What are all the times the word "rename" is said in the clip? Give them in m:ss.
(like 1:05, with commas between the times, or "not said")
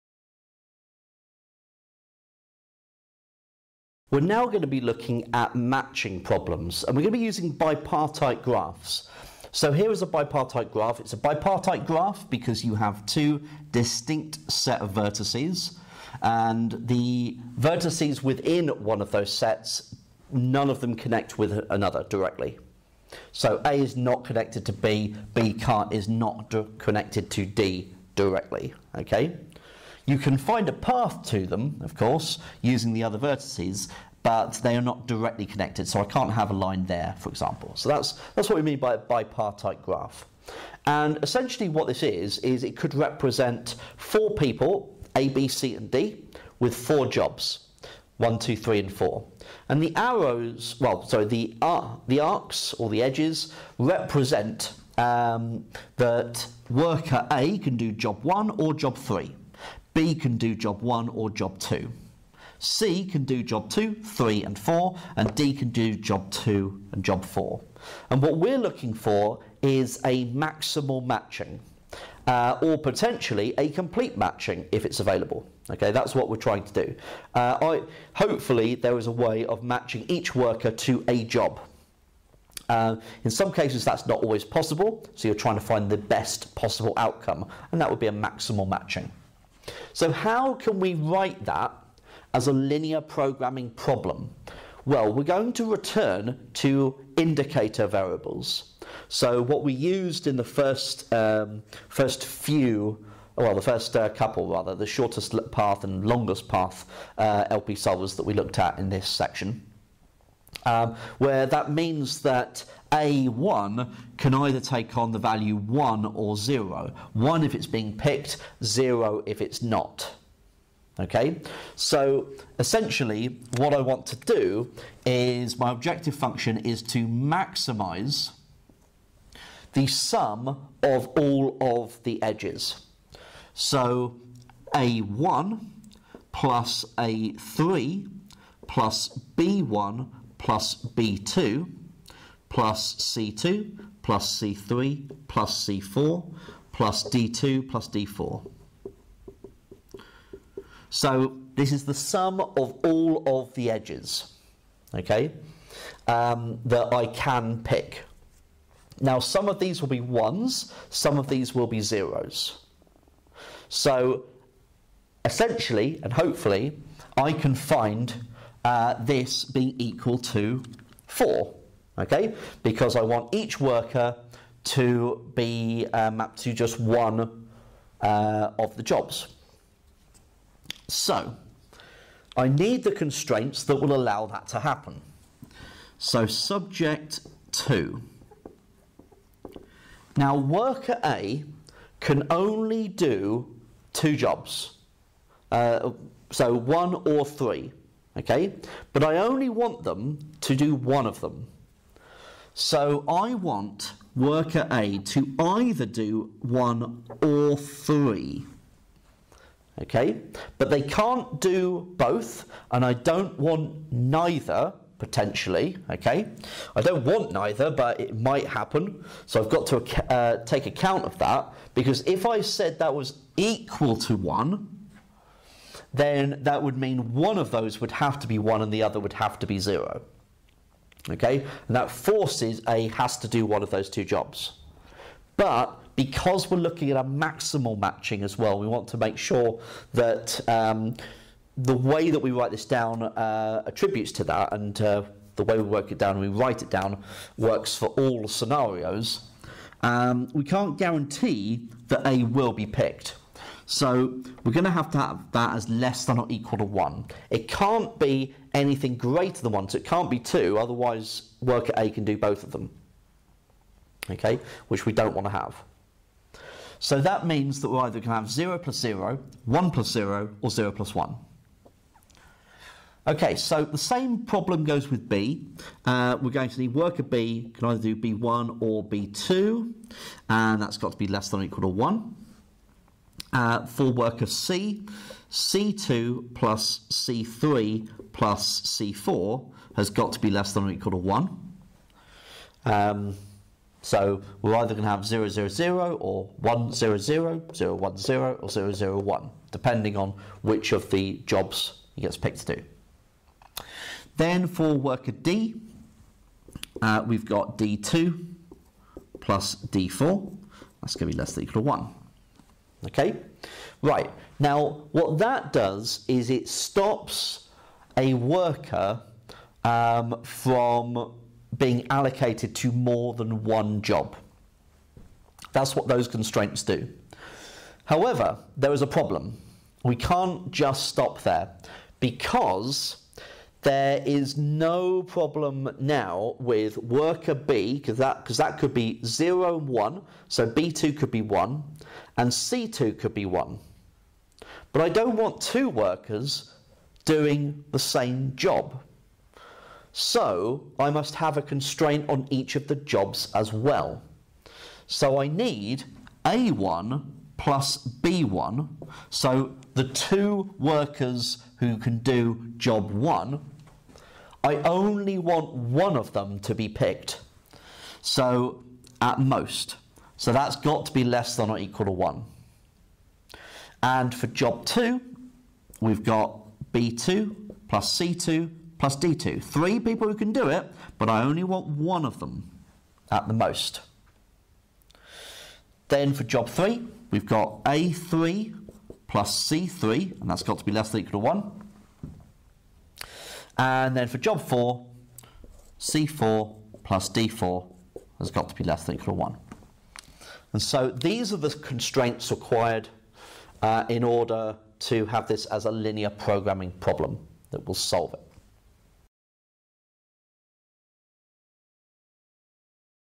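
not said.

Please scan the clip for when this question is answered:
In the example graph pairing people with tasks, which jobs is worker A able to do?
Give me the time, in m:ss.
0:57.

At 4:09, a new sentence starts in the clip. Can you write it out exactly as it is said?
Um, we can't guarantee that A will be picked.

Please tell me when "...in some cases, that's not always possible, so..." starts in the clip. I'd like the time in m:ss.
1:23.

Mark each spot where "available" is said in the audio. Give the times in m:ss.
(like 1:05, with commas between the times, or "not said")
1:14.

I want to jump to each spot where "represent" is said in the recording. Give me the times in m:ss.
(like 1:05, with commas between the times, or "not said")
0:42, 0:53.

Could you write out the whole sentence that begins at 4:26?
So that means that we're either going to have 0 plus 0, 1 plus 0, or 0 plus 1.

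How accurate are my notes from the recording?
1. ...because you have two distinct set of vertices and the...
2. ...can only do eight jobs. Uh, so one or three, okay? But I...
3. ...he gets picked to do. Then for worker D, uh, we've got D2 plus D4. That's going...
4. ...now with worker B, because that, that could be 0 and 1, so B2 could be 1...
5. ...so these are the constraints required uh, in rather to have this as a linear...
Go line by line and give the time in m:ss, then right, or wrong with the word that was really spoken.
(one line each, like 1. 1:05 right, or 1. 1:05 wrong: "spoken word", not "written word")
1. 0:12 right
2. 3:11 wrong: "two", not "eight"
3. 5:01 right
4. 5:35 right
5. 6:40 wrong: "order", not "rather".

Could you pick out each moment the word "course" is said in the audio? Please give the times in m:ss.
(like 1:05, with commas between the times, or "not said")
0:31.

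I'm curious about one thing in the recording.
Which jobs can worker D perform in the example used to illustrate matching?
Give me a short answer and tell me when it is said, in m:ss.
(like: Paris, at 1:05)
jobs 2 and 4, at 1:05.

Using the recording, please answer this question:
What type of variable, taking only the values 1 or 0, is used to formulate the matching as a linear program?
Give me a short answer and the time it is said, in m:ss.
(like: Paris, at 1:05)
indicator variables, at 1:37.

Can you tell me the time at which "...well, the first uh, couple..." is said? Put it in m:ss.
1:43.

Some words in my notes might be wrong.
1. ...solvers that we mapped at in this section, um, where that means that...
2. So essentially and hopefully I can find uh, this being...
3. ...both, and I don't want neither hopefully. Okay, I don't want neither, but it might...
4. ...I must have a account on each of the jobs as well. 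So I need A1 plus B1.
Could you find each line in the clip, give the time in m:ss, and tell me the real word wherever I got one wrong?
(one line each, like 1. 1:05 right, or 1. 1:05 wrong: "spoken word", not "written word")
1. 1:47 wrong: "looked", not "mapped"
2. 2:43 right
3. 3:31 wrong: "potentially", not "hopefully"
4. 5:50 wrong: "constraint", not "account".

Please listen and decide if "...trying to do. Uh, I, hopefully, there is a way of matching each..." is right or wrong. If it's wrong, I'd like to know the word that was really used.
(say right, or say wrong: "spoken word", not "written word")
right.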